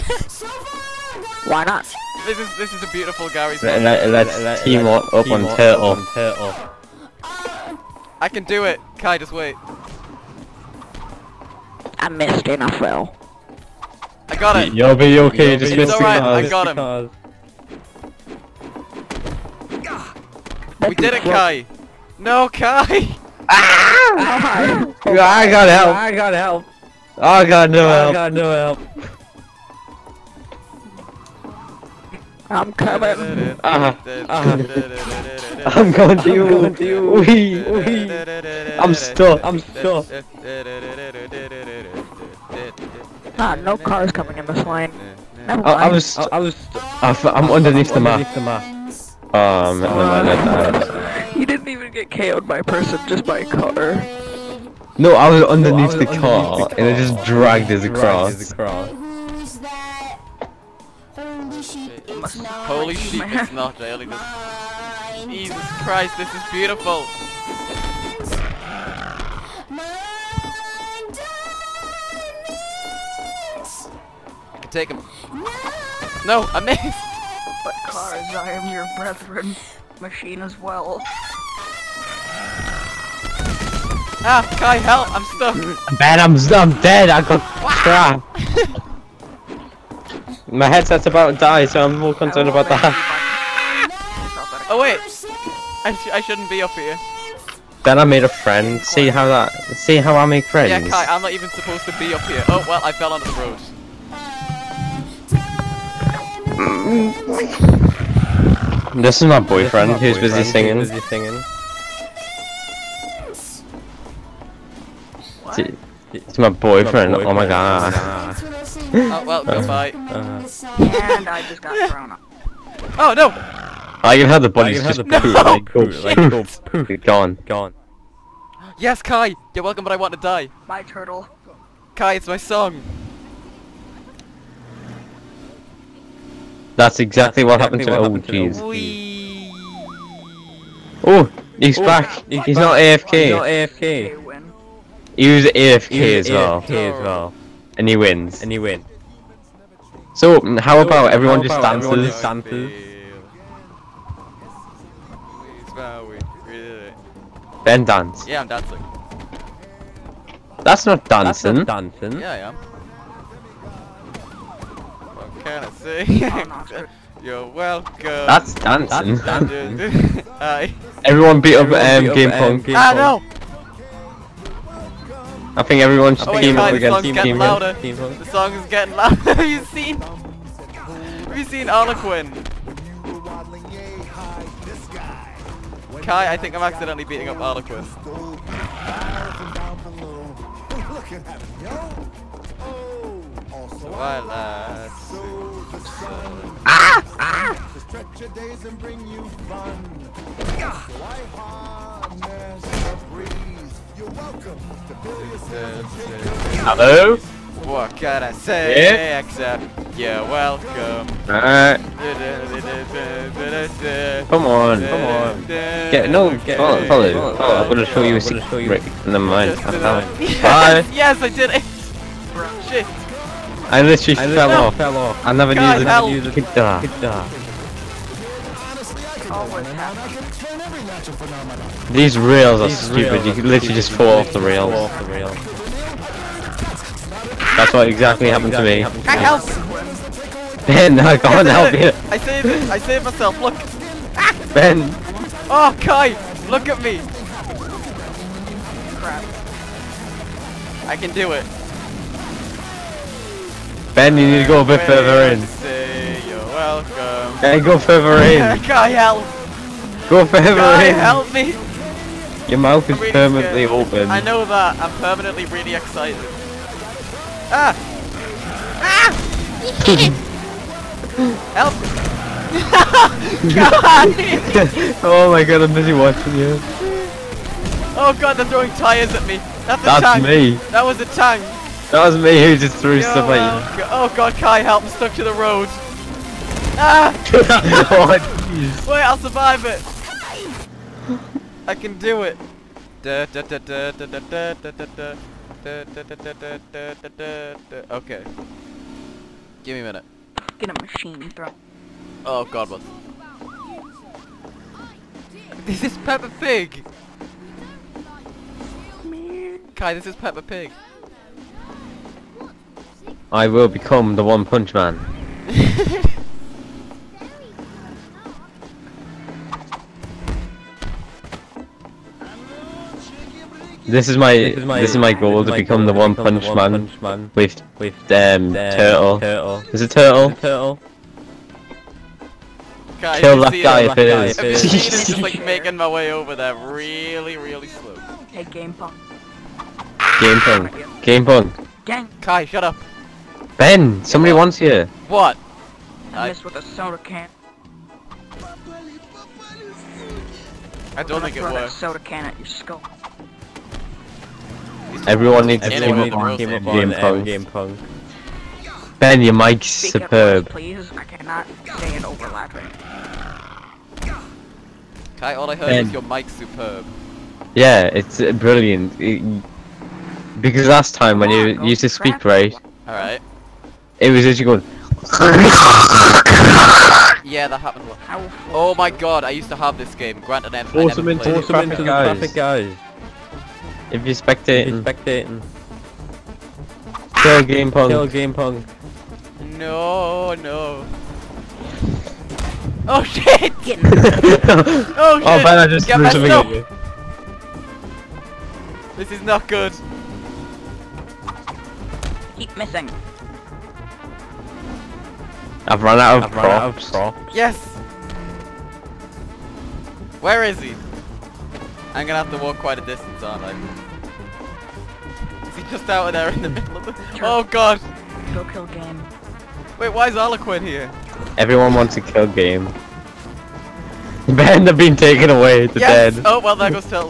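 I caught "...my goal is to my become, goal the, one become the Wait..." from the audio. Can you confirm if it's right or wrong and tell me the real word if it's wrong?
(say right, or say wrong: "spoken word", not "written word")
wrong: "One", not "Wait".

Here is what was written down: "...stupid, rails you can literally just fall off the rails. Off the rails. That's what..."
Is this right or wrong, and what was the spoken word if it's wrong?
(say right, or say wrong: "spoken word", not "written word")
right.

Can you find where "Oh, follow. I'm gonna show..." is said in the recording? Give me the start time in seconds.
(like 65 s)
217 s.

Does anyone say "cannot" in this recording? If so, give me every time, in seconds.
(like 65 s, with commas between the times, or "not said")
361 s.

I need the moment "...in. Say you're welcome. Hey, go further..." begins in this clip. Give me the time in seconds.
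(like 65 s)
255 s.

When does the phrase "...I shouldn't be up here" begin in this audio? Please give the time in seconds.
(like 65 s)
96 s.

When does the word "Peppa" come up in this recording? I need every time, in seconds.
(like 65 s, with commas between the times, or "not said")
305 s, 310 s.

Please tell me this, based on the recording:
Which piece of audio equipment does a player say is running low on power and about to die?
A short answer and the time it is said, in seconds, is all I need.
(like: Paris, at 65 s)
headset, at 90 s.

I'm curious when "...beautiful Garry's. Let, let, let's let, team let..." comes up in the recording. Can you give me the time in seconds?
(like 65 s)
2 s.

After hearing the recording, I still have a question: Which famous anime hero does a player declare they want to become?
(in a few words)
One Punch Man.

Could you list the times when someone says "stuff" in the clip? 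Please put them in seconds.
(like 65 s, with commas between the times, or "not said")
283 s.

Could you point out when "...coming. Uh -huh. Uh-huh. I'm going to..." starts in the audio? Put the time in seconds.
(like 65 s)
32 s.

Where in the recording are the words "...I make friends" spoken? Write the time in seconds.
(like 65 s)
100 s.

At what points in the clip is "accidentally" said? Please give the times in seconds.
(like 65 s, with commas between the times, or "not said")
186 s.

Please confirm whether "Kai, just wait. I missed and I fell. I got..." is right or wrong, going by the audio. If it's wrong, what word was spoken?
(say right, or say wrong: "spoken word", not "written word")
right.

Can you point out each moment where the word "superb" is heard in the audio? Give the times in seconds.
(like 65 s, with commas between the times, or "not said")
359 s, 366 s.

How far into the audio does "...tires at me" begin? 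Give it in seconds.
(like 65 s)
278 s.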